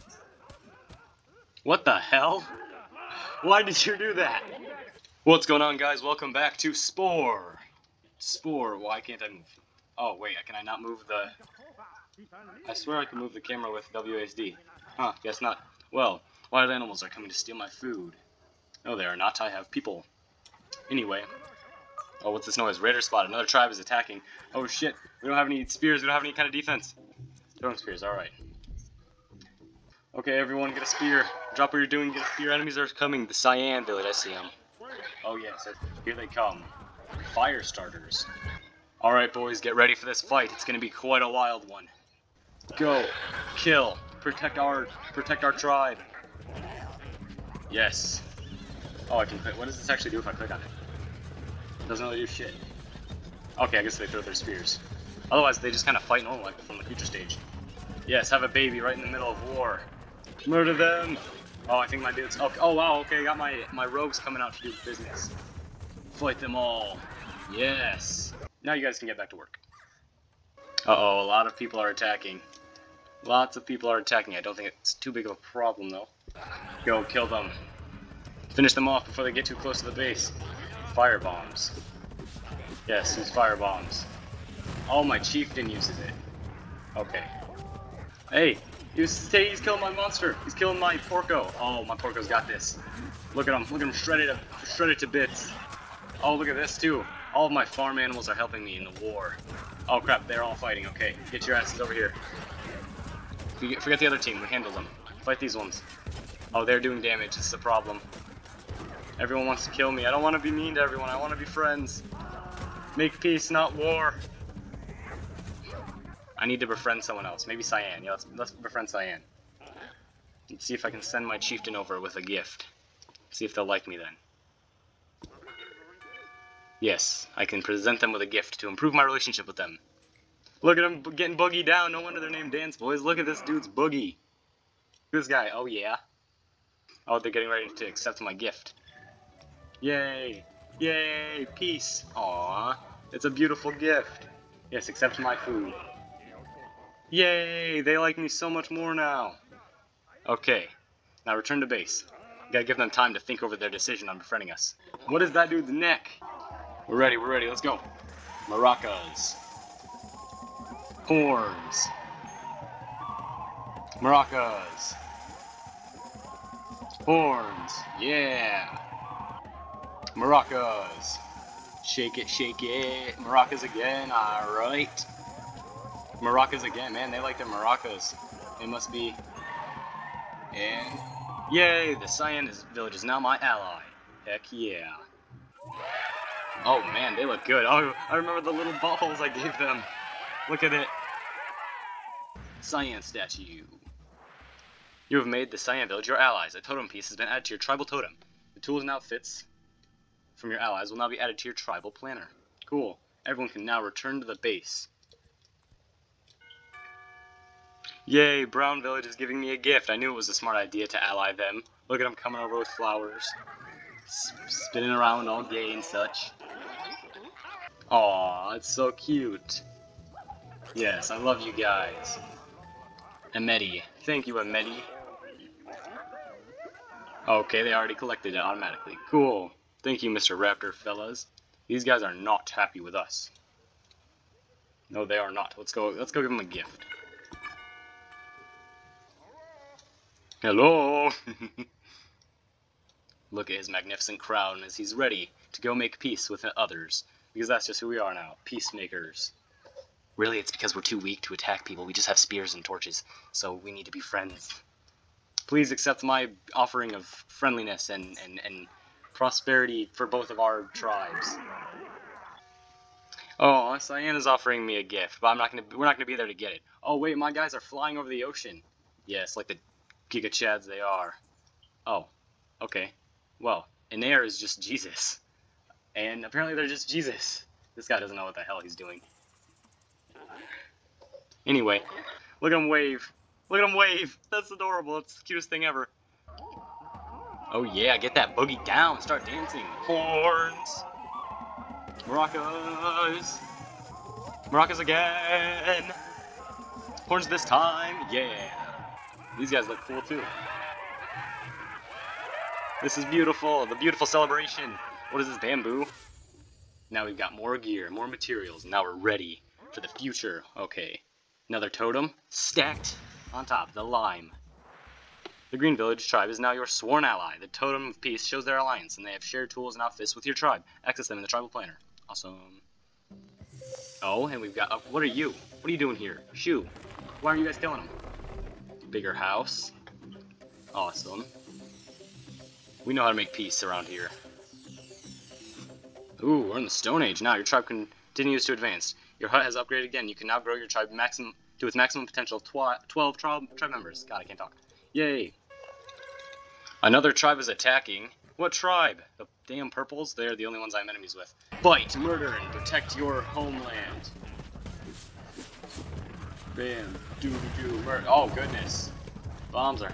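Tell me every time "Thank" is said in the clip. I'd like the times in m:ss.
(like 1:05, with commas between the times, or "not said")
3:44, 3:49.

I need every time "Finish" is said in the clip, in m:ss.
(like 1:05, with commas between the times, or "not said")
1:18.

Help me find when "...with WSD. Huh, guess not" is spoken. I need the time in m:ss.
0:13.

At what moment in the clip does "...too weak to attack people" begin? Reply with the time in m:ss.
4:10.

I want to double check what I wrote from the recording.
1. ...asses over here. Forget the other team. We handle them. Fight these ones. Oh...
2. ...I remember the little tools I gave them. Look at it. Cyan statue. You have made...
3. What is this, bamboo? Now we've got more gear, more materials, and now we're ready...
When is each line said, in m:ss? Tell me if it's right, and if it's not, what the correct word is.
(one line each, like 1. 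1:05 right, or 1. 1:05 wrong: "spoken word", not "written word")
1. 1:41 right
2. 3:08 wrong: "balls", not "tools"
3. 5:05 right.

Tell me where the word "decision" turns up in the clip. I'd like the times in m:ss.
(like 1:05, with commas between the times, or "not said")
2:33.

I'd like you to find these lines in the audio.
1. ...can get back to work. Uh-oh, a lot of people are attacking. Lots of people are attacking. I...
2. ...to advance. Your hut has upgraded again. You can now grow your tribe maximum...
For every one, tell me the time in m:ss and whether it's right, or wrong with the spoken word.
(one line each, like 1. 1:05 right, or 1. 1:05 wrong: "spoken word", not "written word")
1. 1:08 right
2. 5:38 right.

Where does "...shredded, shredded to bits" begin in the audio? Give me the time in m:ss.
1:33.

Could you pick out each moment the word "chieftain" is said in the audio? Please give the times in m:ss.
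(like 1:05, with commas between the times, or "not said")
1:25, 2:01.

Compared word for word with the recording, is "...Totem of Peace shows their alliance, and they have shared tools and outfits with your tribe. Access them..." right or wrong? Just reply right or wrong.
right.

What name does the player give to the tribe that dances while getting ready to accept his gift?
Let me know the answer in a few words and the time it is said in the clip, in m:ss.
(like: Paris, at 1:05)
Dance Boys, at 2:12.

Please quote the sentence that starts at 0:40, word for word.
It's going to be quite a wild one.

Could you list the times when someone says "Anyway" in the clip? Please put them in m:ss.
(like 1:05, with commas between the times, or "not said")
0:20, 4:41.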